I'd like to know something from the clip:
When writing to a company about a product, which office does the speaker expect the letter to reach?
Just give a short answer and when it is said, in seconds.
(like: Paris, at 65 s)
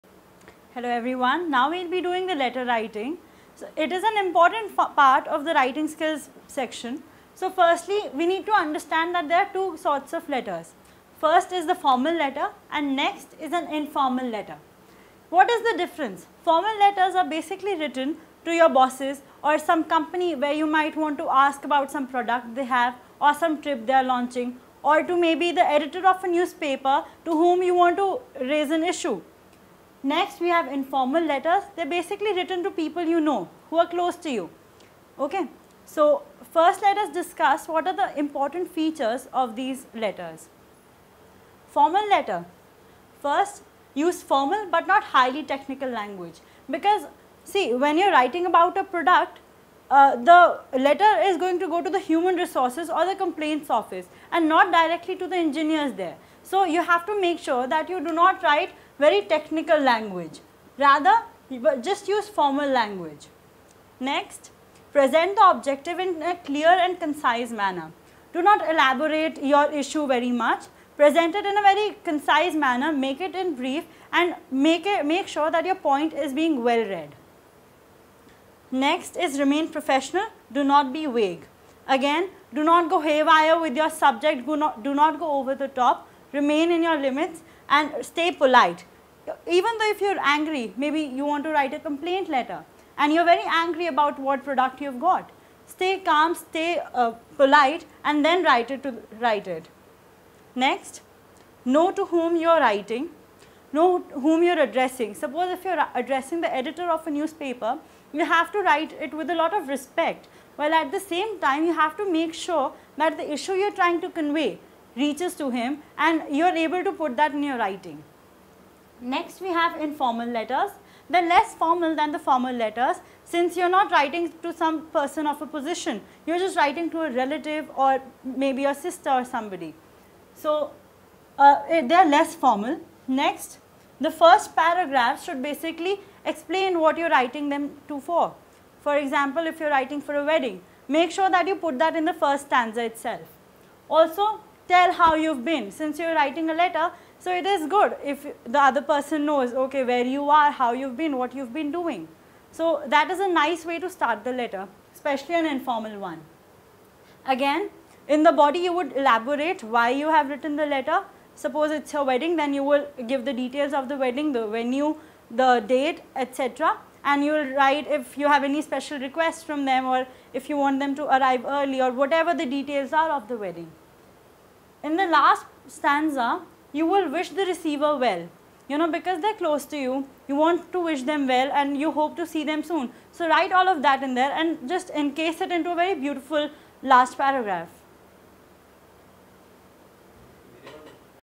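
complaints office, at 53 s.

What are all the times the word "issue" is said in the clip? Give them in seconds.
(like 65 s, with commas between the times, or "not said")
28 s, 69 s, 113 s.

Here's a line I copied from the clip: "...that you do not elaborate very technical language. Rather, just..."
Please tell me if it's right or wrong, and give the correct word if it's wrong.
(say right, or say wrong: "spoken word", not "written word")
wrong: "write", not "elaborate".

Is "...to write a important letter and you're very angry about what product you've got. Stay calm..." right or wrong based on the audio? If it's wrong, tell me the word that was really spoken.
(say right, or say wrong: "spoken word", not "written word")
wrong: "complaint", not "important".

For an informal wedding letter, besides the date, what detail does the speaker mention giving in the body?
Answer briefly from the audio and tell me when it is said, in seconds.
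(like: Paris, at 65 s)
the venue, at 164 s.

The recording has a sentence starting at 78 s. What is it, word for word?
Next is remain professional, do not be vague.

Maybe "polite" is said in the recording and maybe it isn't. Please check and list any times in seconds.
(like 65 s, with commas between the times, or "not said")
88 s, 97 s.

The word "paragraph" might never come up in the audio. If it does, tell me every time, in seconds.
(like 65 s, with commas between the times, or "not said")
134 s, 187 s.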